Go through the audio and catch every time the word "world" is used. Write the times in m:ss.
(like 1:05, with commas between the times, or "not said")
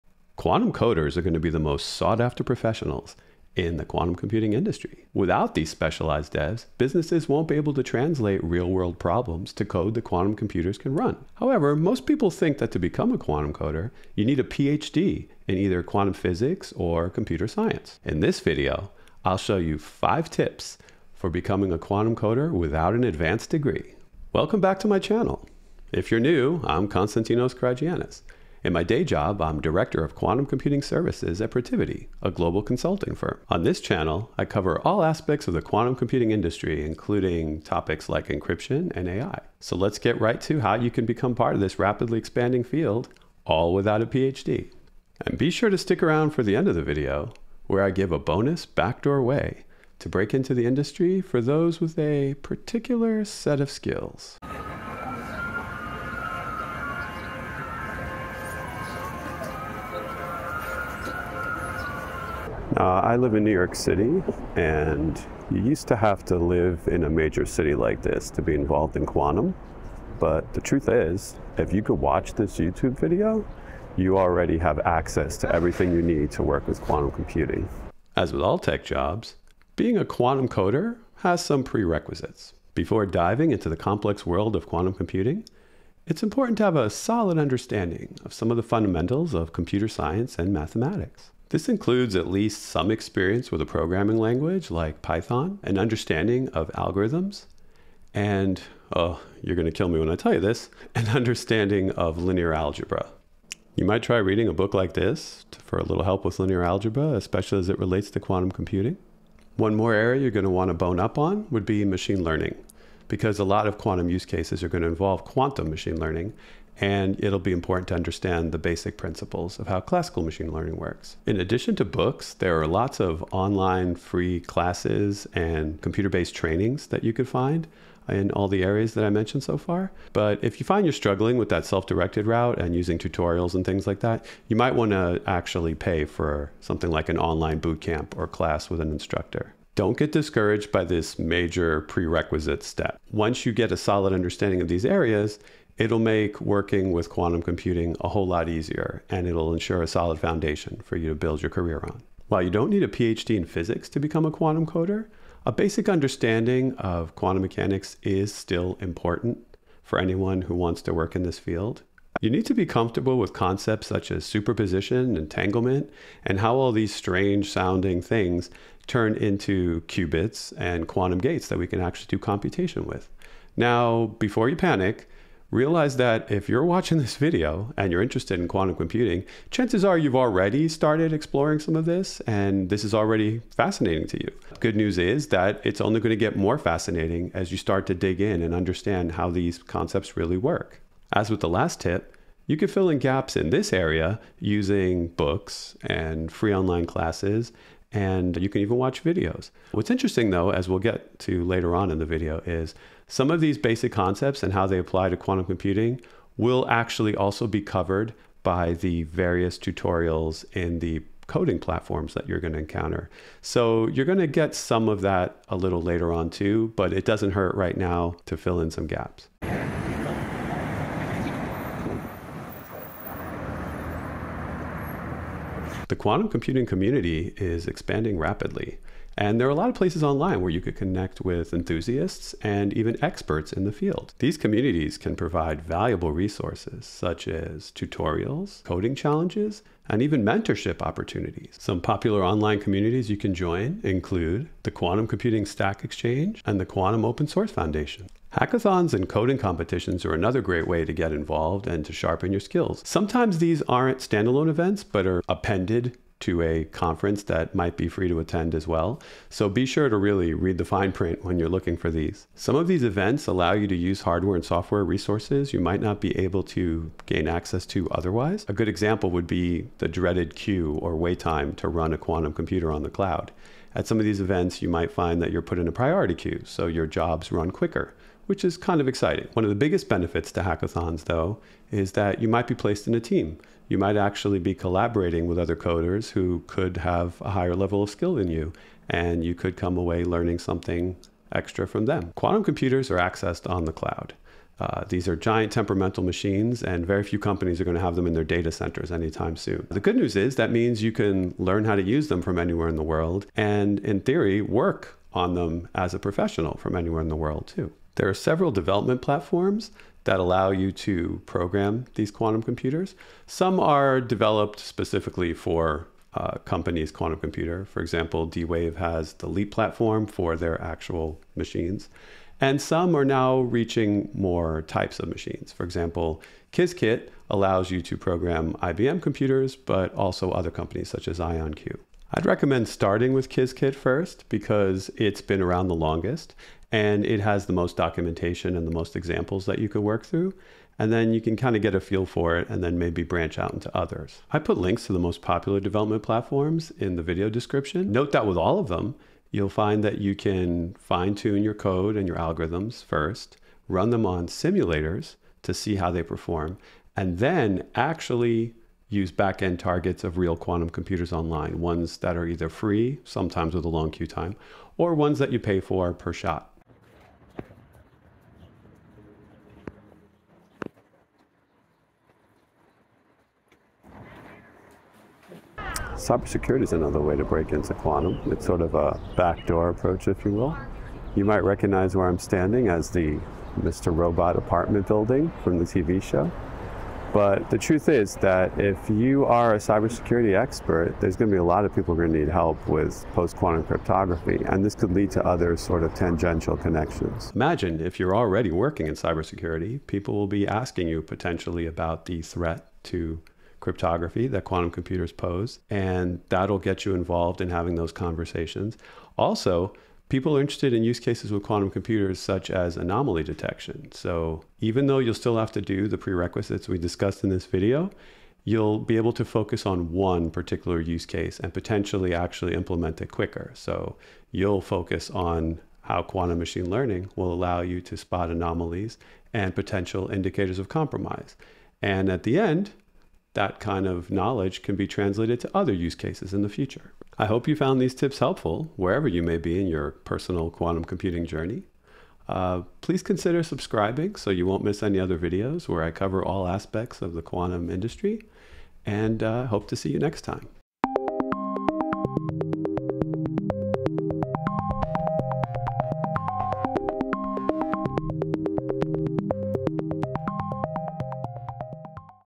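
0:08, 1:24, 5:02, 5:07.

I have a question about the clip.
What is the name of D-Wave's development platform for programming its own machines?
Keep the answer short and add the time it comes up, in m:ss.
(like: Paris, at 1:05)
Leap, at 5:19.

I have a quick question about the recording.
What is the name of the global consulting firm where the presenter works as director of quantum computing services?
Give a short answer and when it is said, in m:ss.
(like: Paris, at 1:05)
Protiviti, at 0:31.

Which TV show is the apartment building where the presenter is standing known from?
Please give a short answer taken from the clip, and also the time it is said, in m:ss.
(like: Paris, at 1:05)
Mr. Robot, at 6:23.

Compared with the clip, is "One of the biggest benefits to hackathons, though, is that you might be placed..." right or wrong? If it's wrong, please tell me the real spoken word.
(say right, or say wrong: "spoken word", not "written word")
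right.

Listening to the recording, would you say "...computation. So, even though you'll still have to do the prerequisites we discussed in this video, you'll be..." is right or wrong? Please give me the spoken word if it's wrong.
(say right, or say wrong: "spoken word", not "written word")
wrong: "detection", not "computation".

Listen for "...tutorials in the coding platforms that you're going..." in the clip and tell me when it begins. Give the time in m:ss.
3:29.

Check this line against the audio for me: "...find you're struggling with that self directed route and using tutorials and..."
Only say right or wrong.
right.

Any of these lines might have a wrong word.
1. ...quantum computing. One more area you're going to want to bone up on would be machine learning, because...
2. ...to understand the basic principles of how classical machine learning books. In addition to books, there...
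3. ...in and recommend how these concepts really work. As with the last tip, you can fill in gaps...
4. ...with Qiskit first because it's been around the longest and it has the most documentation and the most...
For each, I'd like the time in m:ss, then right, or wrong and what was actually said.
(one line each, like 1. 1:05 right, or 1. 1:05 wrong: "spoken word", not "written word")
1. 1:48 right
2. 1:57 wrong: "works", not "books"
3. 3:08 wrong: "understand", not "recommend"
4. 5:33 right.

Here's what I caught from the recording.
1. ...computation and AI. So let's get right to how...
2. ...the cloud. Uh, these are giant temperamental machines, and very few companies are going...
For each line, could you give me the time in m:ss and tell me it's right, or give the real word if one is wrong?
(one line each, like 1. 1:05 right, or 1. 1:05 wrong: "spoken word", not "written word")
1. 0:38 wrong: "encryption", not "computation"
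2. 4:53 right.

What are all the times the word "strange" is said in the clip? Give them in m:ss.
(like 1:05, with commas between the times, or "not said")
2:46.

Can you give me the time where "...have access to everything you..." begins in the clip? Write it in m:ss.
1:14.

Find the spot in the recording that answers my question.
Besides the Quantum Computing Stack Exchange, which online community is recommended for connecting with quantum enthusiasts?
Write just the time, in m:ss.
4:06.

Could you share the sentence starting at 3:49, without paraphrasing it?
And there are a lot of places online where you could connect with enthusiasts and even experts in the field.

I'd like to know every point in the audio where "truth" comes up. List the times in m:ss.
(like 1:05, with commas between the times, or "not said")
1:10, 6:27.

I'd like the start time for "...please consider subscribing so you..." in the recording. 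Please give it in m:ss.
7:22.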